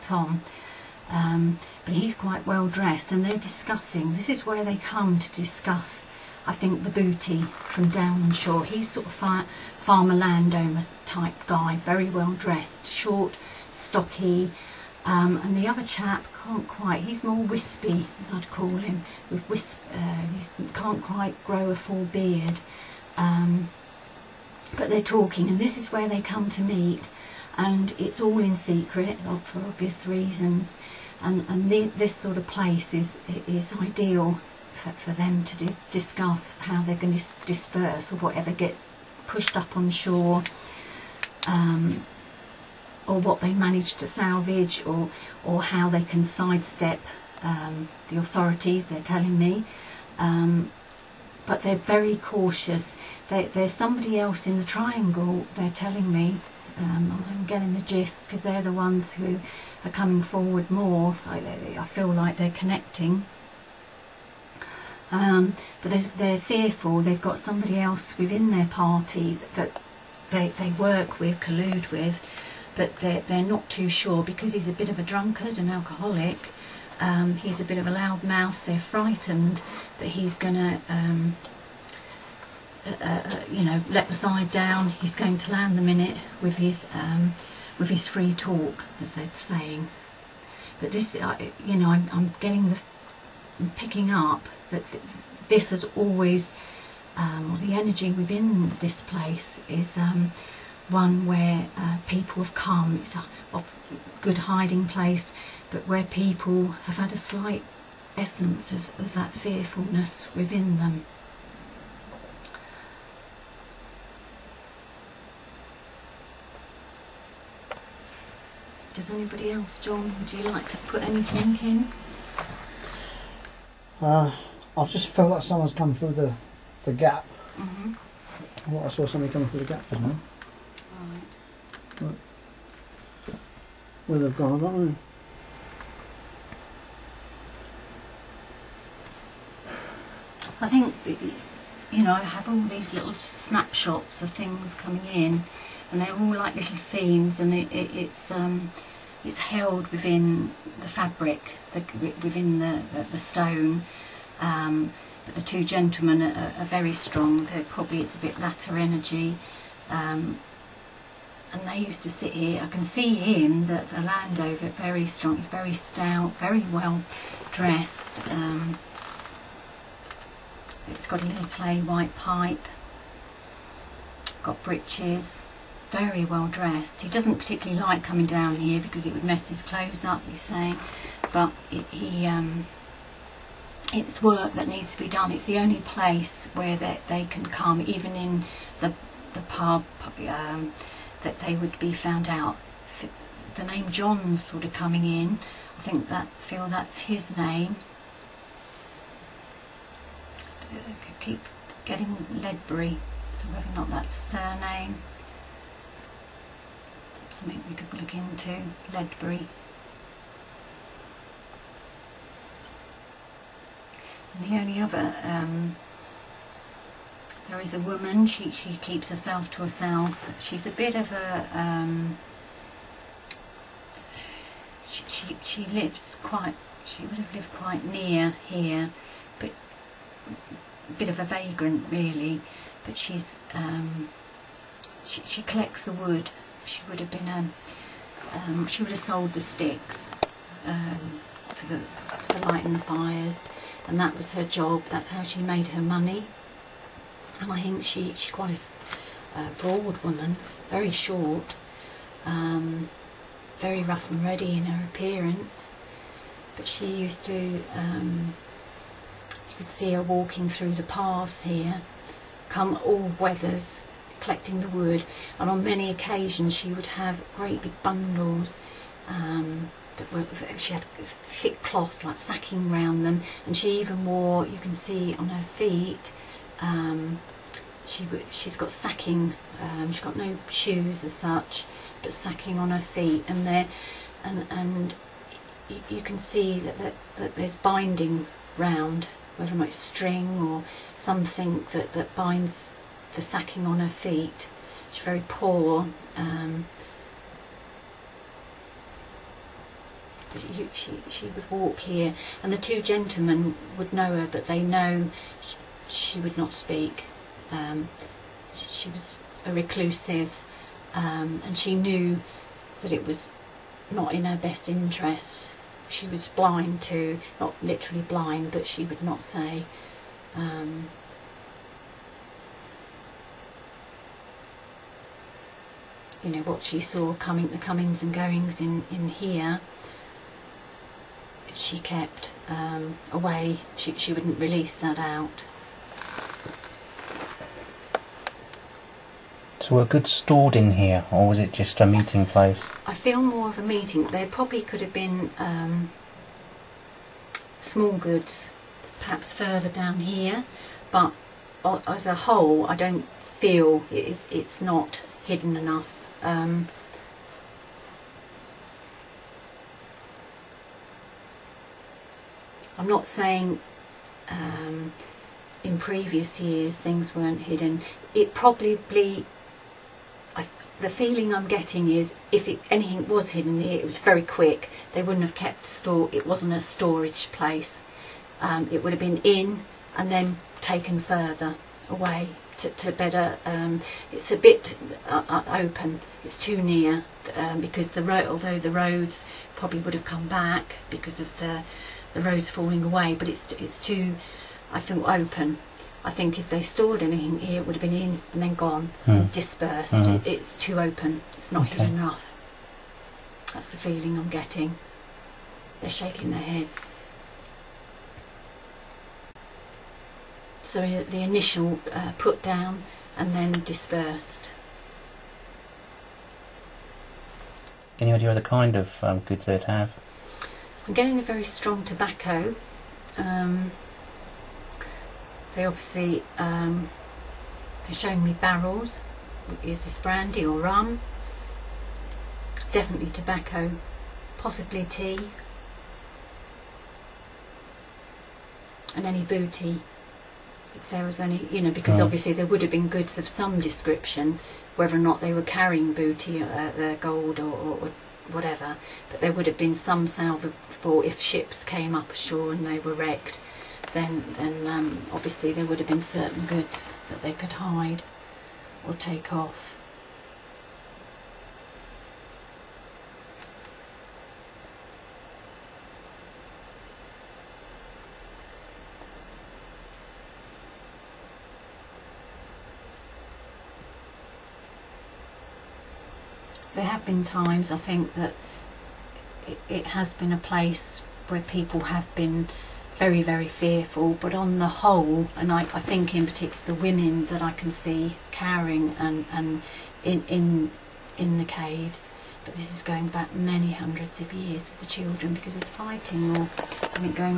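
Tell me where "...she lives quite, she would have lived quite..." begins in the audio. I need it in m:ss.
3:45.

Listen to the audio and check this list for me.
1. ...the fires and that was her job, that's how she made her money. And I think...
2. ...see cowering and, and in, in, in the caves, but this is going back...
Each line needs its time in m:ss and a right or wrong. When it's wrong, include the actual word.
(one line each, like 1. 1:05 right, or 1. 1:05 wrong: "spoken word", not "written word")
1. 4:02 right
2. 8:07 right.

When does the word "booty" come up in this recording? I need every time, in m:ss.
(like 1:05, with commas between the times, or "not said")
0:06, 7:19, 7:25.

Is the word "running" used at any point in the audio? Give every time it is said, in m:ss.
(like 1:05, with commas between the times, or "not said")
not said.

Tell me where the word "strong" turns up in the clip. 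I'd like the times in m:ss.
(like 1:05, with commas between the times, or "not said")
2:36, 2:45, 7:01.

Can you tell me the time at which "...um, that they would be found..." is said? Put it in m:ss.
3:10.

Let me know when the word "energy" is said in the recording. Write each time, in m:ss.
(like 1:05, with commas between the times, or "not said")
1:37, 2:38.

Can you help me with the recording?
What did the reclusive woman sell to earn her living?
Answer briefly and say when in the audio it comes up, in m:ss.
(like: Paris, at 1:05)
sticks, at 3:58.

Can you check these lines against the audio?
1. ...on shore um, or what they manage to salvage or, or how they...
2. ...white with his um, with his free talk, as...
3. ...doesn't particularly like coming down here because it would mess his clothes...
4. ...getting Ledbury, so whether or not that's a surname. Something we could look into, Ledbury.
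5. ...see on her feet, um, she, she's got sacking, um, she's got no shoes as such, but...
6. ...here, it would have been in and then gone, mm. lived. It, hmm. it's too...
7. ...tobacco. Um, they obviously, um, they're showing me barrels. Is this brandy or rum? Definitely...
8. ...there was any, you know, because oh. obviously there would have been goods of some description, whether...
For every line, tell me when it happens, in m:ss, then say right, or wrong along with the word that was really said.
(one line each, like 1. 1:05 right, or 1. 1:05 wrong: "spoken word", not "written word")
1. 0:39 right
2. 1:25 wrong: "minute", not "white"
3. 2:57 right
4. 3:21 right
5. 4:34 right
6. 6:37 wrong: "dispersed", not "lived"
7. 7:01 right
8. 7:20 right.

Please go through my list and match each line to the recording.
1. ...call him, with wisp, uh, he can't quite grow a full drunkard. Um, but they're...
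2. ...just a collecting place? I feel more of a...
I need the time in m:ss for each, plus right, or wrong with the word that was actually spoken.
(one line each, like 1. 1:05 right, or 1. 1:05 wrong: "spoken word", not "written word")
1. 0:18 wrong: "beard", not "drunkard"
2. 5:41 wrong: "meeting", not "collecting".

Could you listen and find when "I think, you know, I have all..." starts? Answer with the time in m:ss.
2:20.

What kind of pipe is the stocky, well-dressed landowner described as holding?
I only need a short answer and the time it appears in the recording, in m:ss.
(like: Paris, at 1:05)
clay white pipe, at 2:51.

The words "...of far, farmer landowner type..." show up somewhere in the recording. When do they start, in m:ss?
0:09.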